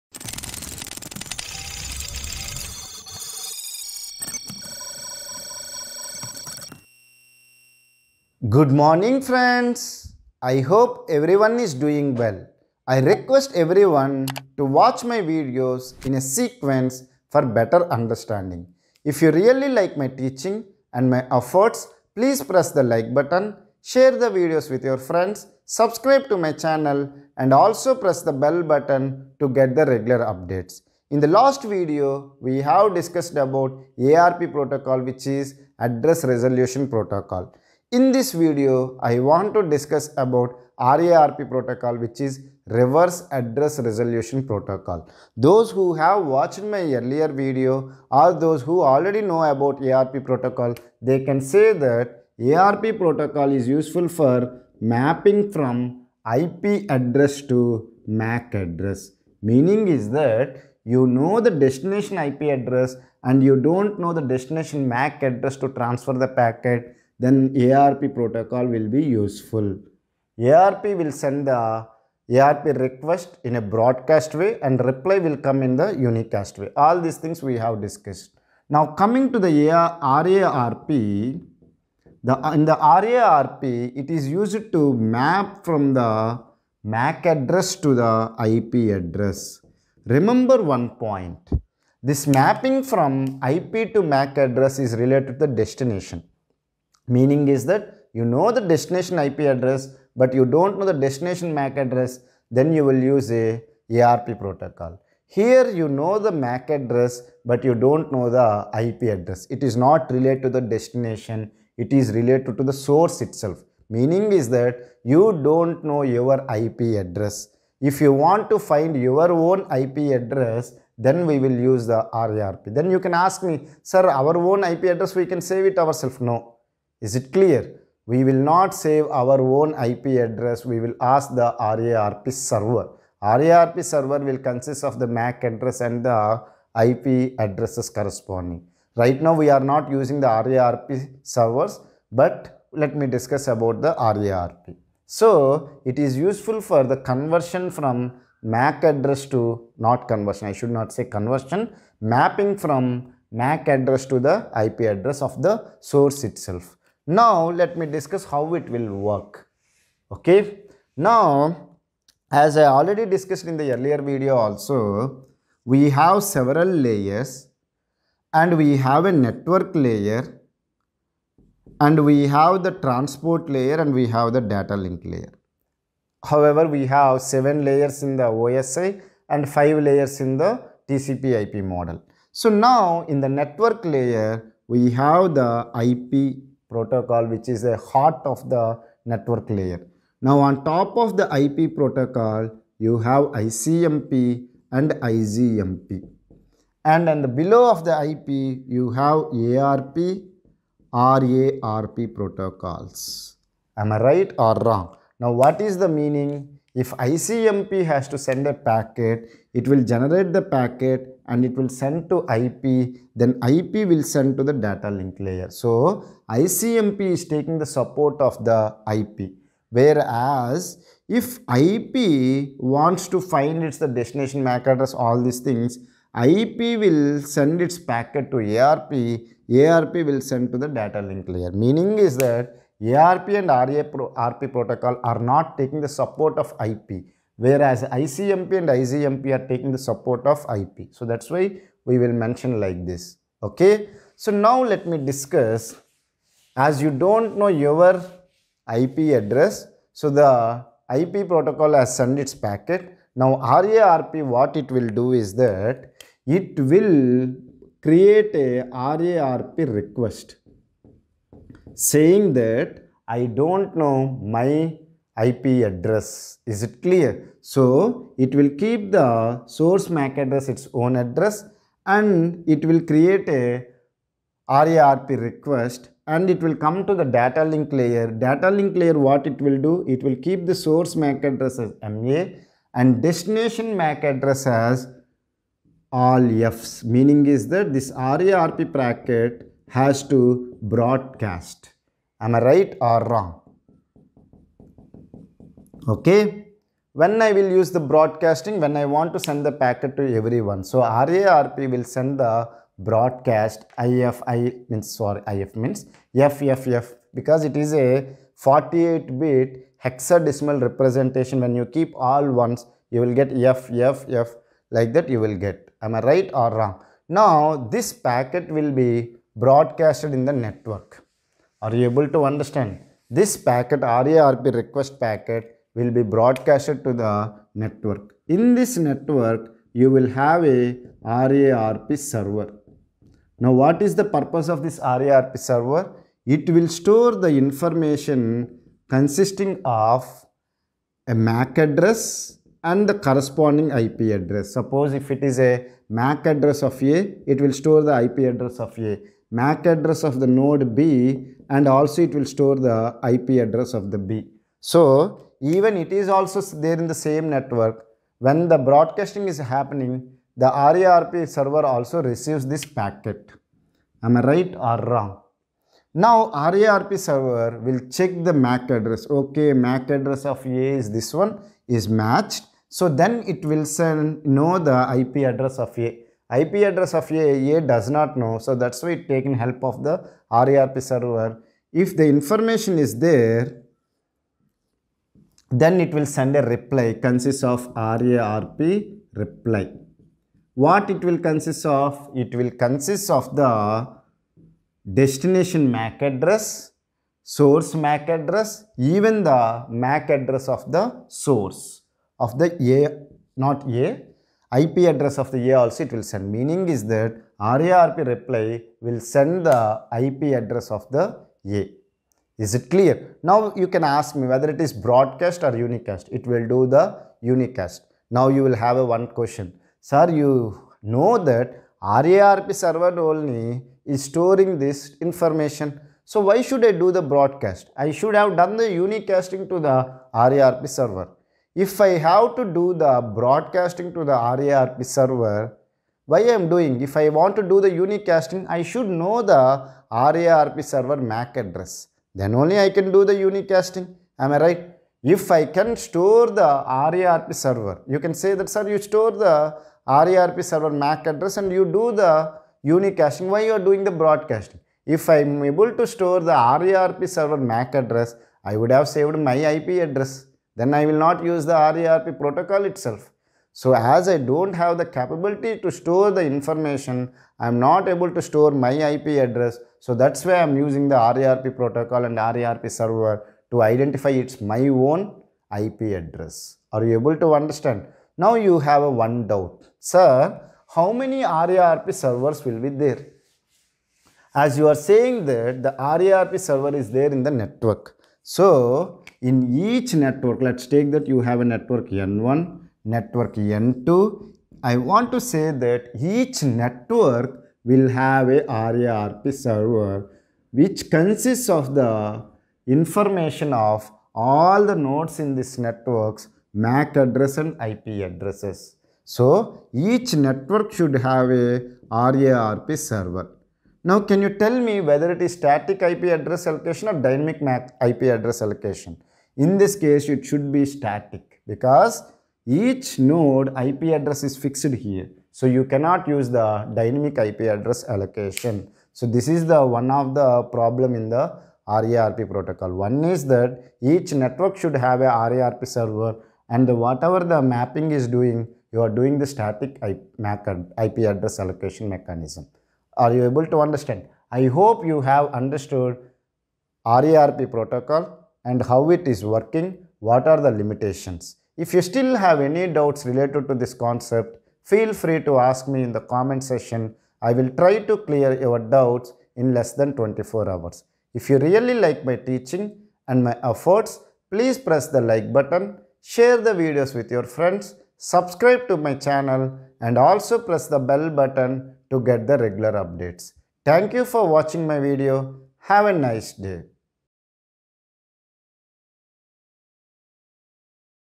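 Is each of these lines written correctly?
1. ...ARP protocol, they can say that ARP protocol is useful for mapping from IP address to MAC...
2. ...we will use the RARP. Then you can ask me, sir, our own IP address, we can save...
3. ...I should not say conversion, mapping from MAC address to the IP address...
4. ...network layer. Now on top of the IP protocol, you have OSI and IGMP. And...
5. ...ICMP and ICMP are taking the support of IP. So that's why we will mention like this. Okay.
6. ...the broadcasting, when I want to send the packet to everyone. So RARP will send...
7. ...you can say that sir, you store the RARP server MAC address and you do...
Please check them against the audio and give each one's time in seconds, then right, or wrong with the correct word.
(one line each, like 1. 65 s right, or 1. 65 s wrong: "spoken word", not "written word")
1. 49 s right
2. 121 s right
3. 150 s right
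4. 189 s wrong: "ICMP", not "OSI"
5. 237 s right
6. 297 s right
7. 447 s right.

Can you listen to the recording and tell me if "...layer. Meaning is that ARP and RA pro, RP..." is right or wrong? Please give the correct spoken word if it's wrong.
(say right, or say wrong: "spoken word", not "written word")
right.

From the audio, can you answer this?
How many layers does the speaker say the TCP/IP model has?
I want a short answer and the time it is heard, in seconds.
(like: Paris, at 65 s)
5, at 179 s.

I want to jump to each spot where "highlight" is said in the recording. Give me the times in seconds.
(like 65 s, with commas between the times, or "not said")
not said.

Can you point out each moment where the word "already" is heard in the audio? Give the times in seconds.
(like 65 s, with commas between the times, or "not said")
48 s, 162 s.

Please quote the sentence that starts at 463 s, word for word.
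So as I don't have the capability to store the information, I am not able to store my IP address.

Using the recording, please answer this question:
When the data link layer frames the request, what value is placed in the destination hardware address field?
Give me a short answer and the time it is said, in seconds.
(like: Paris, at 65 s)
All Fs, at 285 s.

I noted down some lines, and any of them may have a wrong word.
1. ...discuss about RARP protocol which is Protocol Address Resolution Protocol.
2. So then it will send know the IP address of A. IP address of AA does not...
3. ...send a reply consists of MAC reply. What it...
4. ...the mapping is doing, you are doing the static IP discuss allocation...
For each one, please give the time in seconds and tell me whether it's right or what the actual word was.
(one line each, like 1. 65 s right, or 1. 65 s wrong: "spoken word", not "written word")
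1. 39 s wrong: "Reverse", not "Protocol"
2. 372 s right
3. 386 s wrong: "RARP", not "MAC"
4. 537 s wrong: "address", not "discuss".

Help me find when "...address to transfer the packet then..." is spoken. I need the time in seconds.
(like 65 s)
65 s.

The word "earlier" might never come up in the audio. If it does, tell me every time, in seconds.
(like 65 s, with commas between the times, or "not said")
46 s, 163 s.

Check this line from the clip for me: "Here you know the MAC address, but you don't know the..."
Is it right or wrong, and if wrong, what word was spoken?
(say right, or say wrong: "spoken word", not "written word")
right.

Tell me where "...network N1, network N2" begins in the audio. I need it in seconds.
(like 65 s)
491 s.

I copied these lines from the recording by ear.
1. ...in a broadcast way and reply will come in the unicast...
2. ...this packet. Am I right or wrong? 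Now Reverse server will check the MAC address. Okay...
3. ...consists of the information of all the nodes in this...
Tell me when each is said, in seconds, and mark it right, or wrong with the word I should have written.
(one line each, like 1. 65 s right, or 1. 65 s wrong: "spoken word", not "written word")
1. 73 s right
2. 362 s wrong: "RARP", not "Reverse"
3. 500 s right.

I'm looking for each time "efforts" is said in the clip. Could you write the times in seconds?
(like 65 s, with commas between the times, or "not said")
21 s, 563 s.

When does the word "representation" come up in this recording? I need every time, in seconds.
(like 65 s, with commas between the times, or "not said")
310 s.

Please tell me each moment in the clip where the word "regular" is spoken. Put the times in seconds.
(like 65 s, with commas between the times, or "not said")
29 s, 572 s.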